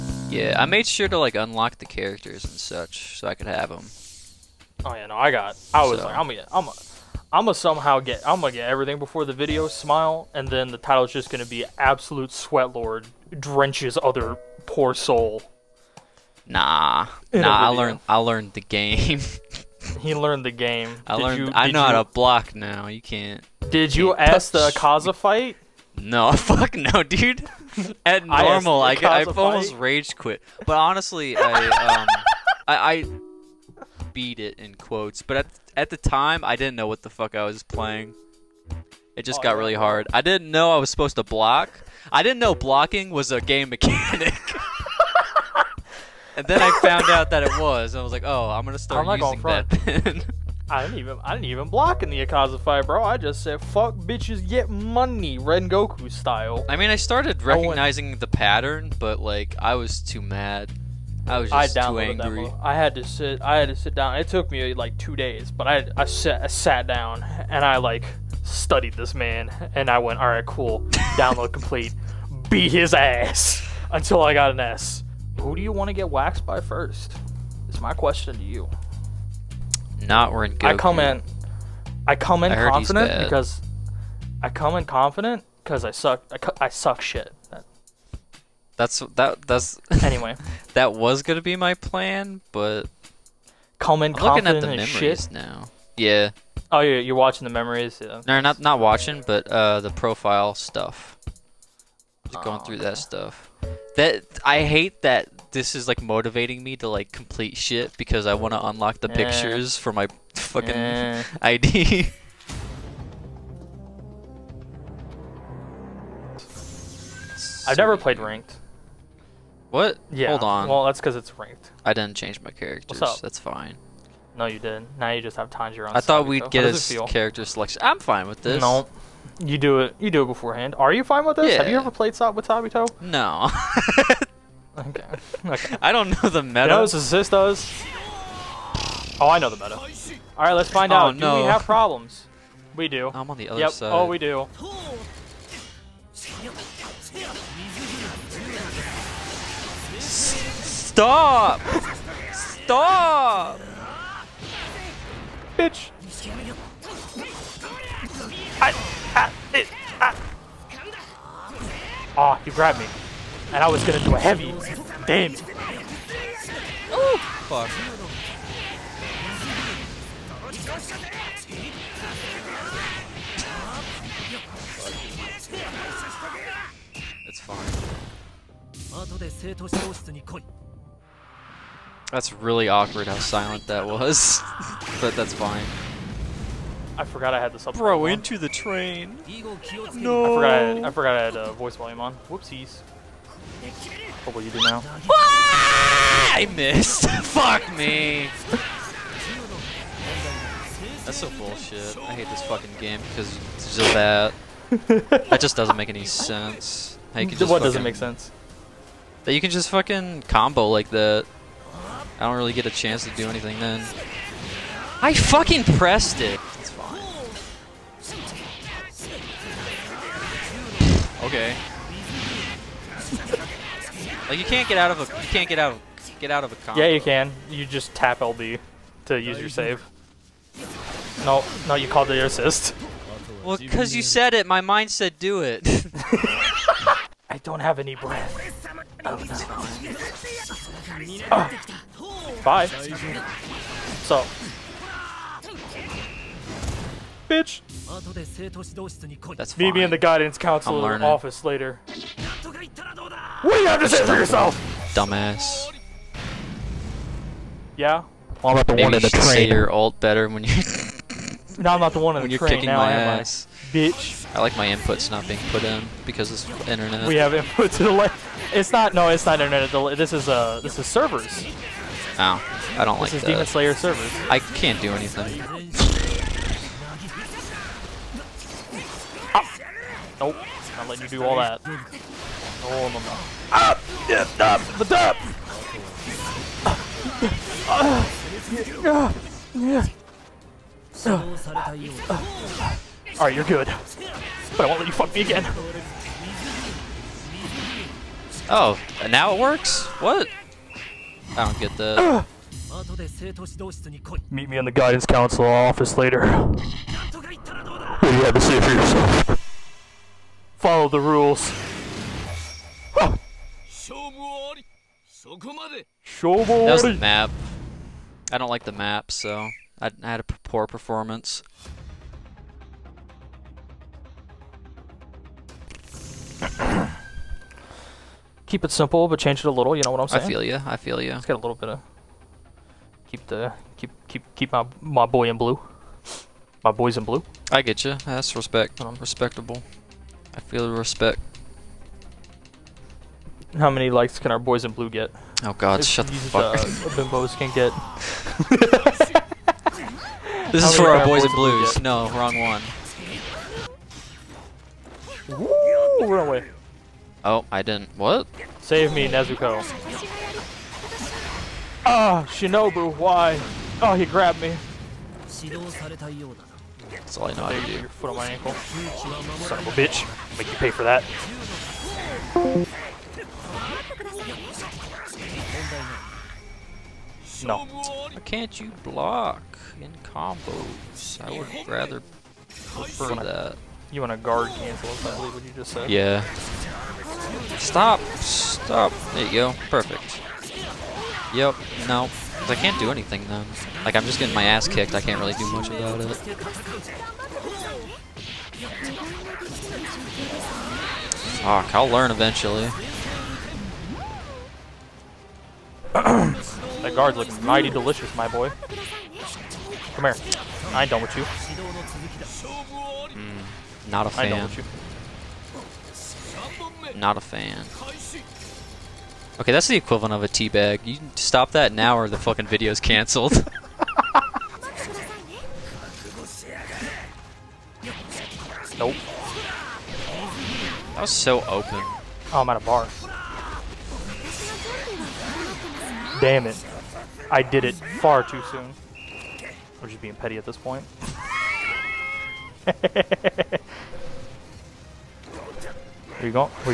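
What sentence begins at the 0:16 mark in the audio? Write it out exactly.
Nah, nah, I learned, I learned the game.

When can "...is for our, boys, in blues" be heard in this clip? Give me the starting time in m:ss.
5:50.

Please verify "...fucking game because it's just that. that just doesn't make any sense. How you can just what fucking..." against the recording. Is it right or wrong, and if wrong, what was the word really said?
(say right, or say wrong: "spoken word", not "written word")
right.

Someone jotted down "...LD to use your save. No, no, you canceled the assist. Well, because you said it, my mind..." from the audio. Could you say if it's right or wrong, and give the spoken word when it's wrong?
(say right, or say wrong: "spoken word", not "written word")
wrong: "called", not "canceled".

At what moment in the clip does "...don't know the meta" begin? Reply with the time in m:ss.
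2:15.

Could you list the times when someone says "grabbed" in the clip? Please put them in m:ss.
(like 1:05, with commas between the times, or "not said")
2:42, 6:04.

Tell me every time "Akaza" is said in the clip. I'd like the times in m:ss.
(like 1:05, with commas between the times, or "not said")
0:24, 0:52.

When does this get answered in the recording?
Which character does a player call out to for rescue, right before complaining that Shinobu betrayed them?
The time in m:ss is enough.
5:59.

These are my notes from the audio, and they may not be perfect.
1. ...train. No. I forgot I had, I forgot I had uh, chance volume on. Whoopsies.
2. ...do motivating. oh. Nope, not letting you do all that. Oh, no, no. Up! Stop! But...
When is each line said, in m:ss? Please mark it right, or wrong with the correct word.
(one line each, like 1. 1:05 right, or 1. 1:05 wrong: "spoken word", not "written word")
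1. 3:08 wrong: "voice", not "chance"
2. 4:34 wrong: "anything", not "motivating".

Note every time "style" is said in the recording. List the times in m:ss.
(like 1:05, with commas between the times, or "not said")
0:56.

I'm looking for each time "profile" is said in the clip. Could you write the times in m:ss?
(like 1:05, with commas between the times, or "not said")
1:39.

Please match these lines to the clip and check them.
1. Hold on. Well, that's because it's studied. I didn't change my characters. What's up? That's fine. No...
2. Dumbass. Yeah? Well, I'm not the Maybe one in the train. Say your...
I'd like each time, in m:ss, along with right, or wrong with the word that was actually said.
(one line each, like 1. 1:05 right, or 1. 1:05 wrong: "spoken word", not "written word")
1. 2:00 wrong: "ranked", not "studied"
2. 4:14 right.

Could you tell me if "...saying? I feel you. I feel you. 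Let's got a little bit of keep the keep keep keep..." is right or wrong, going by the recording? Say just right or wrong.
right.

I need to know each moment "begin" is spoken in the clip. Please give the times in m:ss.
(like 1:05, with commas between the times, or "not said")
not said.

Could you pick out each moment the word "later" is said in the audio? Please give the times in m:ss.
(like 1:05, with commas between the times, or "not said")
4:11, 5:05.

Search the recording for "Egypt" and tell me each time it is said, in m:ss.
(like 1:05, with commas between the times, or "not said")
not said.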